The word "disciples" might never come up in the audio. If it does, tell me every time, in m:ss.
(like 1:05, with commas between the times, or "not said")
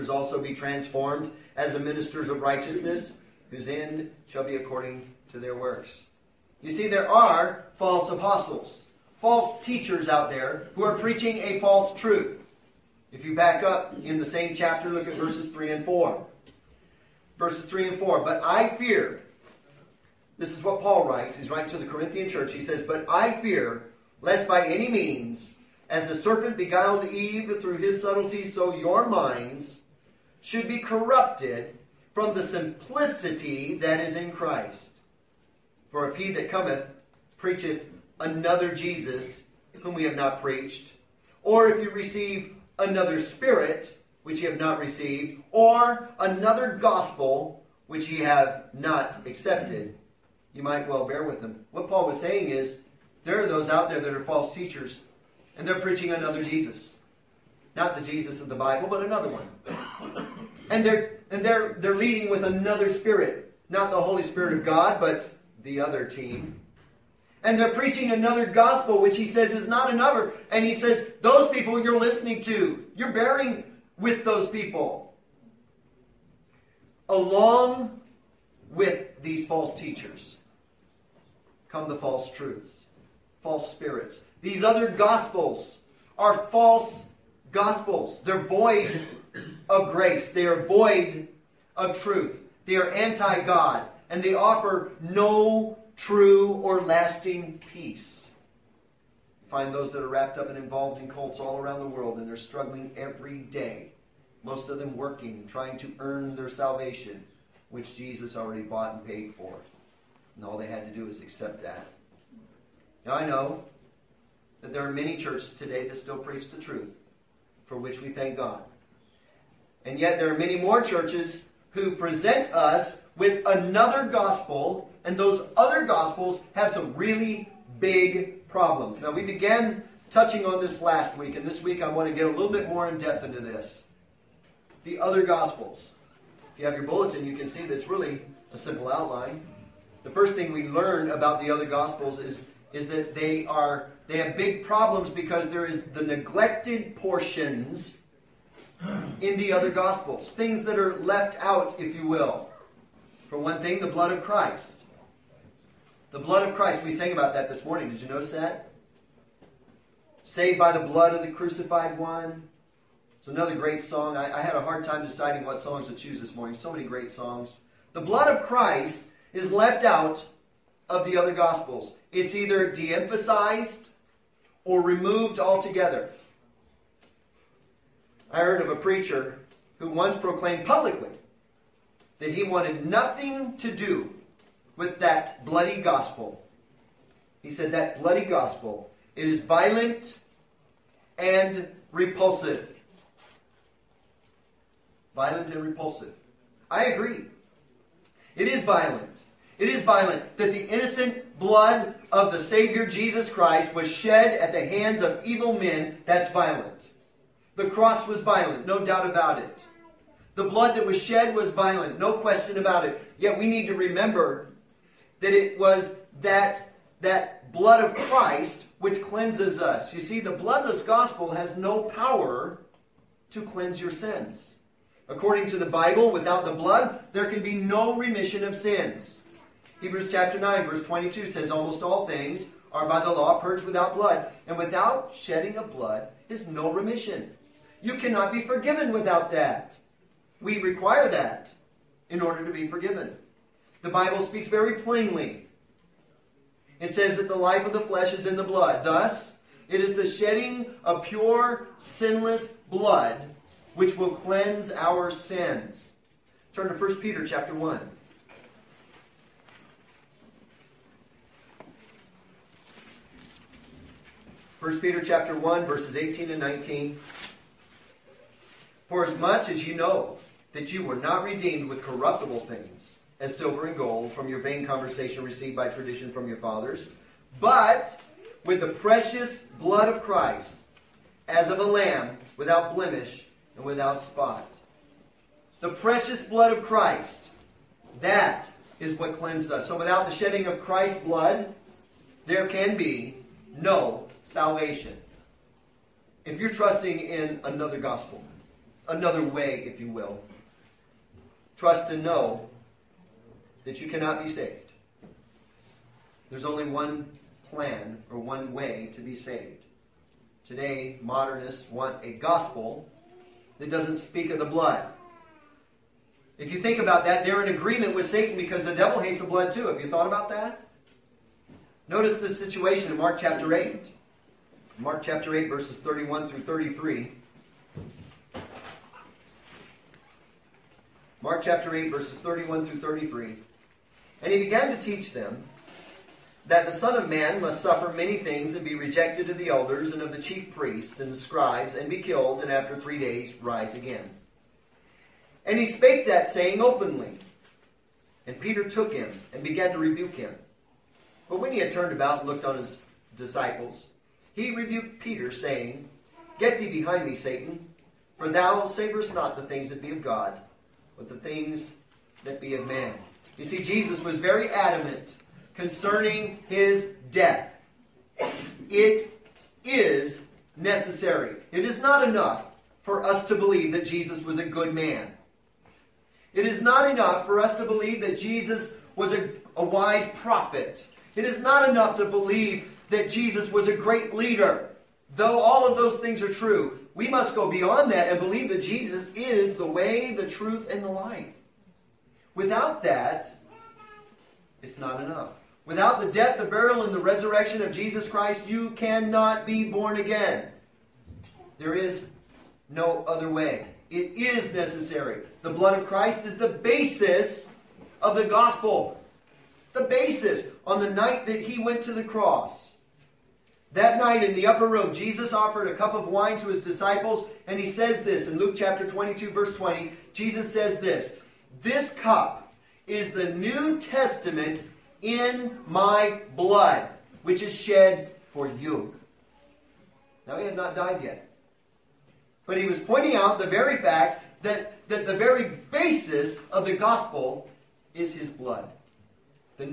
5:53, 6:56.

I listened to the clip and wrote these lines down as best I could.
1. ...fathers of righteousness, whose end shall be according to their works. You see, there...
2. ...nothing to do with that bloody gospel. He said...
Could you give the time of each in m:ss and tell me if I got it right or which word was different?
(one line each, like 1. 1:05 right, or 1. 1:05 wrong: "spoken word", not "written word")
1. 0:01 wrong: "ministers", not "fathers"
2. 3:02 right.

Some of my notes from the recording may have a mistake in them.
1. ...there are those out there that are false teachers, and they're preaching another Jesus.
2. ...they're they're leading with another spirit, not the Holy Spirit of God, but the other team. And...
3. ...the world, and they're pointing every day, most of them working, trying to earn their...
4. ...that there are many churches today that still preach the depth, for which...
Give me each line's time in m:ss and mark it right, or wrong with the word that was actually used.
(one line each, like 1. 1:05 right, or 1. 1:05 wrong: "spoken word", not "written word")
1. 0:53 right
2. 1:01 right
3. 1:41 wrong: "struggling", not "pointing"
4. 1:54 wrong: "truth", not "depth".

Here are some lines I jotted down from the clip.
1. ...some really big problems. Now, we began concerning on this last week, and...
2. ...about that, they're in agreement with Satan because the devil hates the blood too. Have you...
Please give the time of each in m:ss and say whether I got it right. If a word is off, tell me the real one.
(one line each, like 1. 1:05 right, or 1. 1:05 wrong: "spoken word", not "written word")
1. 2:06 wrong: "touching", not "concerning"
2. 5:16 right.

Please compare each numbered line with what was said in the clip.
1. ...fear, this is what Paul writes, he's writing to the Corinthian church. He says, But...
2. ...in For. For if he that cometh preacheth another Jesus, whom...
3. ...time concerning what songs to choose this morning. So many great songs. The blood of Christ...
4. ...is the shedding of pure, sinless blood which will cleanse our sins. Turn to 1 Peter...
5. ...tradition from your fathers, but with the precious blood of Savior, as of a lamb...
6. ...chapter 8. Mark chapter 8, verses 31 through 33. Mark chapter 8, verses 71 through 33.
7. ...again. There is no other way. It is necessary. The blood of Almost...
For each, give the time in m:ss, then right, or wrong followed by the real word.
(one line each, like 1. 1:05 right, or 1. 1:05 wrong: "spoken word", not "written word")
1. 0:18 right
2. 0:34 wrong: "Christ", not "For"
3. 2:44 wrong: "deciding", not "concerning"
4. 4:09 right
5. 4:35 wrong: "Christ", not "Savior"
6. 5:23 wrong: "31", not "71"
7. 6:39 wrong: "Christ", not "Almost".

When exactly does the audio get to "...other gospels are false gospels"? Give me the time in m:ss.
1:24.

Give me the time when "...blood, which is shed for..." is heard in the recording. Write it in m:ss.
7:06.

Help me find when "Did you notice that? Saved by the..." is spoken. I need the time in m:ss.
2:37.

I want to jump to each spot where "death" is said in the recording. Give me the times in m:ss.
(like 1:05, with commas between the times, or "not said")
6:07, 6:36.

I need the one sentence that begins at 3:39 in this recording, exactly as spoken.
You see, the bloodless gospel has no power to cleanse your sins.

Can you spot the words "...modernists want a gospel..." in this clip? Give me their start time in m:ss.
5:11.